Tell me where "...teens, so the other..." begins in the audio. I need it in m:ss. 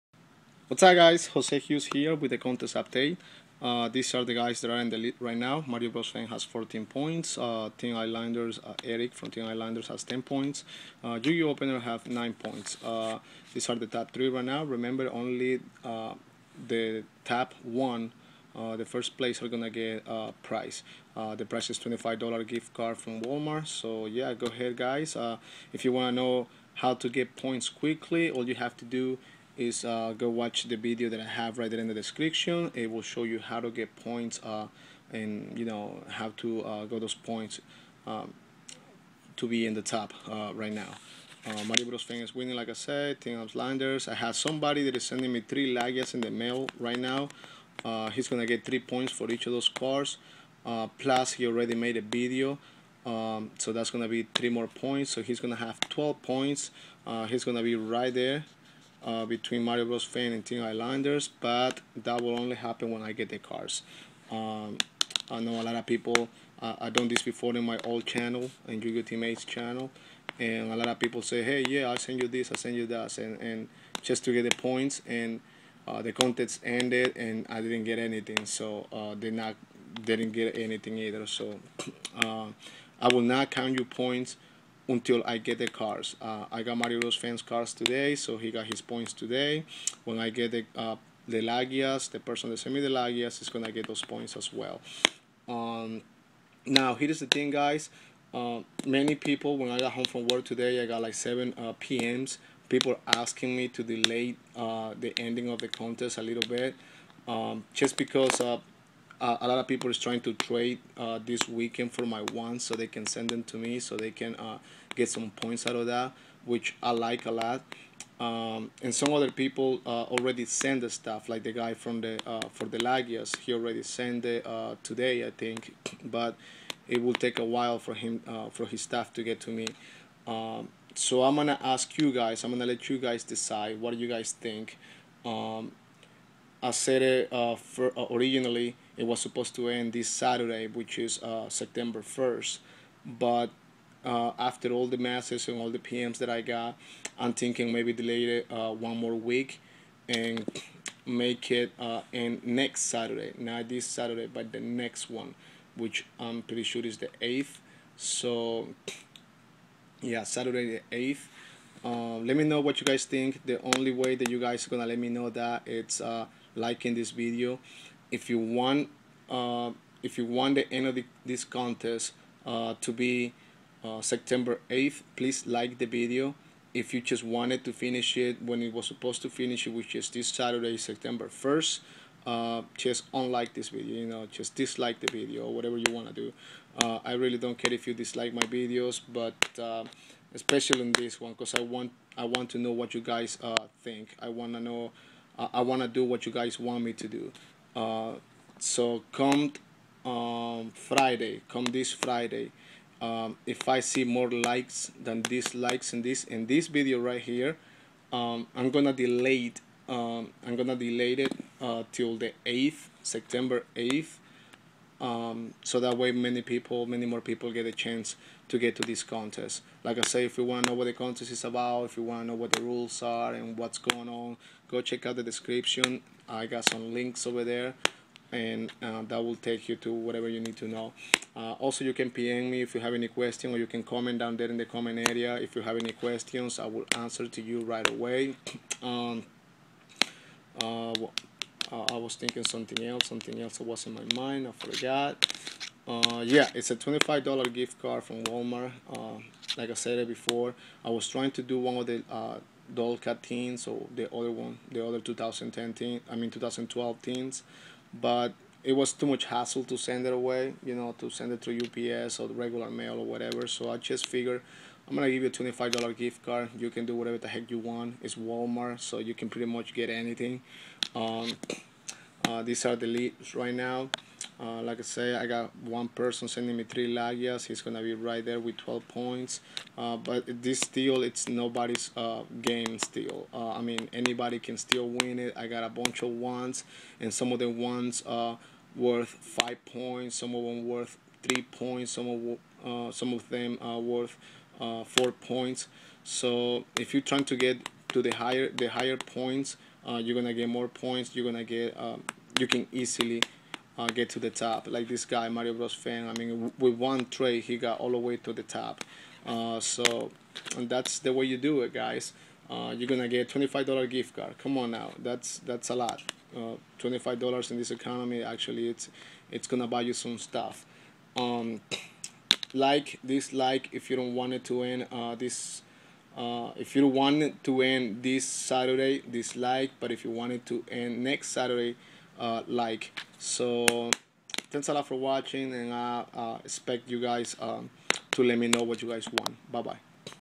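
4:13.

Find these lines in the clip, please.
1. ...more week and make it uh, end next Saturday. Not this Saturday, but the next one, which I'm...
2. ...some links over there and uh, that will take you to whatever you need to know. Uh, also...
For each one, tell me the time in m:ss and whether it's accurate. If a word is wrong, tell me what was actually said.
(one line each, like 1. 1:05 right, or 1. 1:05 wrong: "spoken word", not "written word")
1. 2:28 right
2. 3:46 right.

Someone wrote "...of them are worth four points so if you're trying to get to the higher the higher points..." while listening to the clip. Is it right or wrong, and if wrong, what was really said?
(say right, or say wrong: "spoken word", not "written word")
right.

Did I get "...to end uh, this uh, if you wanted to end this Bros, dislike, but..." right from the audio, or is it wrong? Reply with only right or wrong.
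wrong.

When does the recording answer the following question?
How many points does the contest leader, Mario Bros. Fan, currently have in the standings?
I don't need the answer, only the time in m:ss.
0:06.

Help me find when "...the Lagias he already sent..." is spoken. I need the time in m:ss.
2:02.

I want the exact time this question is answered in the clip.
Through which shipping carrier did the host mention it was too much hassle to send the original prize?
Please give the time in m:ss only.
4:21.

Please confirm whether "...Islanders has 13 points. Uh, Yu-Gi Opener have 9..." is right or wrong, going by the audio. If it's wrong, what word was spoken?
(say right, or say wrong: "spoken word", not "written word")
wrong: "10", not "13".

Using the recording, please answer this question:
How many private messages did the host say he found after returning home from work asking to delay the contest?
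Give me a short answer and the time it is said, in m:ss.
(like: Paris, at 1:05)
7, at 1:41.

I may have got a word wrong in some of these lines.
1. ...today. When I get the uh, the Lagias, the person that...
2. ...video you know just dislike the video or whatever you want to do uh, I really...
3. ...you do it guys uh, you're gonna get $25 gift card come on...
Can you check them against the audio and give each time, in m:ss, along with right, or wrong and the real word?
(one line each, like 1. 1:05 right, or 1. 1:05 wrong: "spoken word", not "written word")
1. 1:29 right
2. 3:03 right
3. 5:11 right.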